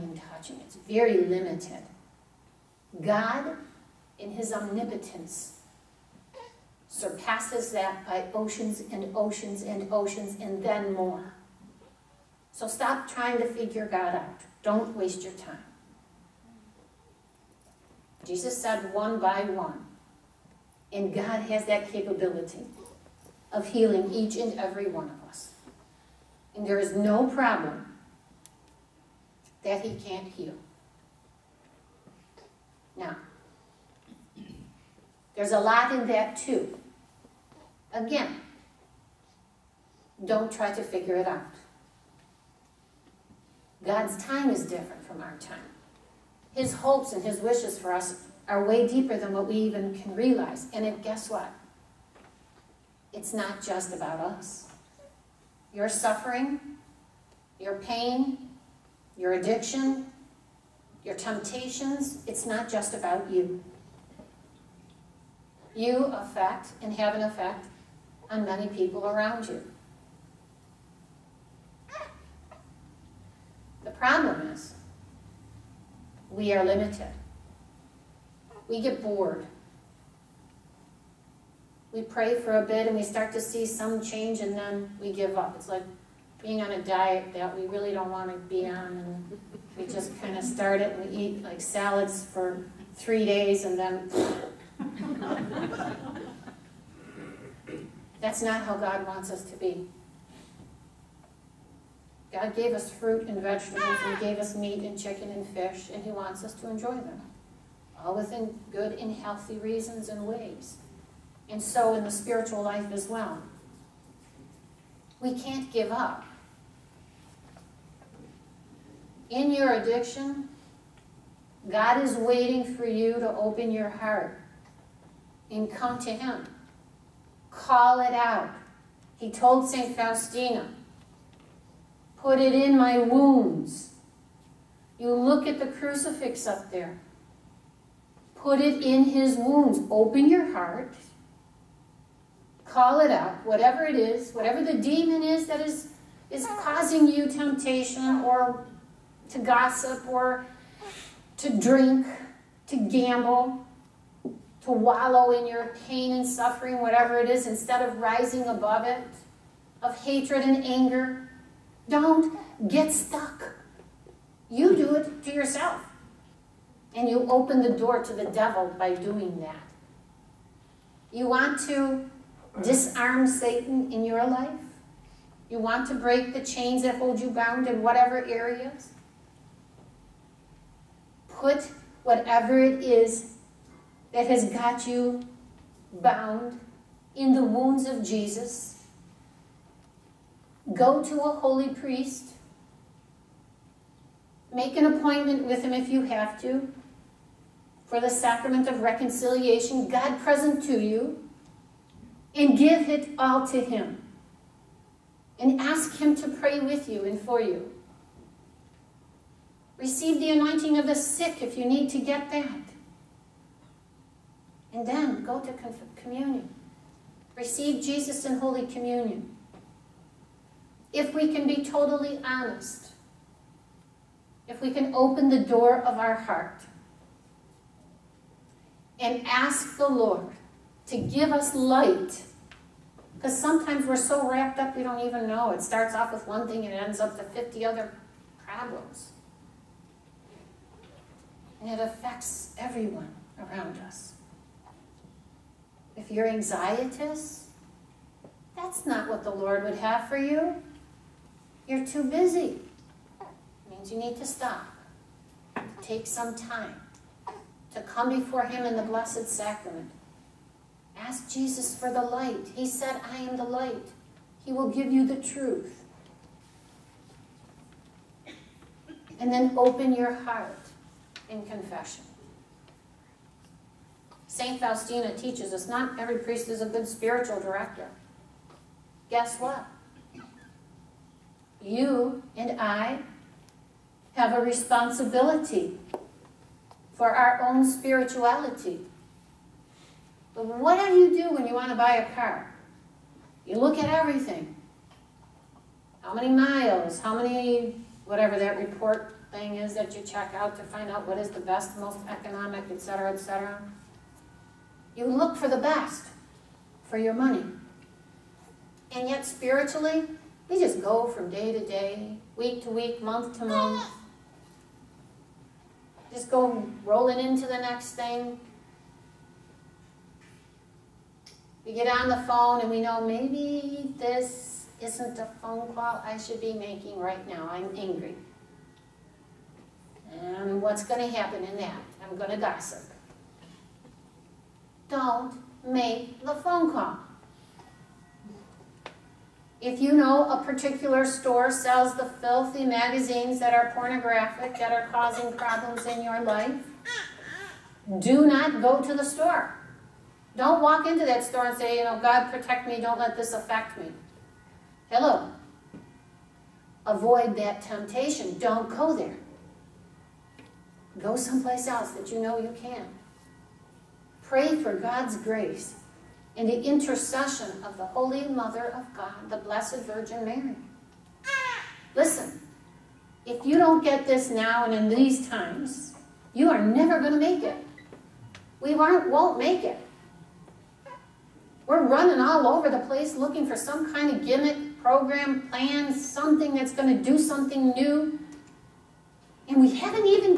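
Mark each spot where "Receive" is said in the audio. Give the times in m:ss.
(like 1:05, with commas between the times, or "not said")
3:29, 3:37.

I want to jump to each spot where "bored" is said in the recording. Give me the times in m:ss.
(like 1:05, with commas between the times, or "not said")
1:19.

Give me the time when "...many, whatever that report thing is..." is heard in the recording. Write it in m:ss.
4:57.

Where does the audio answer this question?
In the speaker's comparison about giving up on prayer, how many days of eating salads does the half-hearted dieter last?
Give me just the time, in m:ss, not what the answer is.
1:32.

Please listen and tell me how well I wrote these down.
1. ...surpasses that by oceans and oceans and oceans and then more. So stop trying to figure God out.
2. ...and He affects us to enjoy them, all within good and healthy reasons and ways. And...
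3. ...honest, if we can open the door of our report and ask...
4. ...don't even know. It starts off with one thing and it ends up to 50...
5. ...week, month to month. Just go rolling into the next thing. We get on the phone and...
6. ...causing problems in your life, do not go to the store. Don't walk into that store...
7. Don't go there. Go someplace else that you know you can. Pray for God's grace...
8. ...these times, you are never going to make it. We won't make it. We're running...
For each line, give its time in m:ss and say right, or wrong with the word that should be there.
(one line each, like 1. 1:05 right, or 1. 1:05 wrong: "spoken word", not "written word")
1. 0:06 right
2. 1:45 wrong: "wants", not "affects"
3. 3:42 wrong: "heart", not "report"
4. 3:54 right
5. 5:12 right
6. 5:44 right
7. 5:58 right
8. 6:14 right.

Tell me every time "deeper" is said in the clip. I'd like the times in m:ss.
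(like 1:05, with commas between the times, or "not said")
0:48.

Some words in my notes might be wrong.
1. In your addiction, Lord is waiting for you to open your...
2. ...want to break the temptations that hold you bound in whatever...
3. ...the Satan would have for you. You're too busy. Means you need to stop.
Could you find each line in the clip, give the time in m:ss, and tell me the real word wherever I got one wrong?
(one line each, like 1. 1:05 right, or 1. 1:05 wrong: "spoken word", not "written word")
1. 1:59 wrong: "God", not "Lord"
2. 2:55 wrong: "chains", not "temptations"
3. 4:09 wrong: "Lord", not "Satan".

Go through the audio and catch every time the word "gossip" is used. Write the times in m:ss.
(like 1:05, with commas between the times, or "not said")
2:29, 5:32.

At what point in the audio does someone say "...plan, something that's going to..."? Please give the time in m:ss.
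6:25.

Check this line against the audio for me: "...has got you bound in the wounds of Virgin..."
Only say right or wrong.
wrong.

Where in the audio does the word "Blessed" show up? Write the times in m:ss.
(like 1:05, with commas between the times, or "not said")
4:18, 6:09.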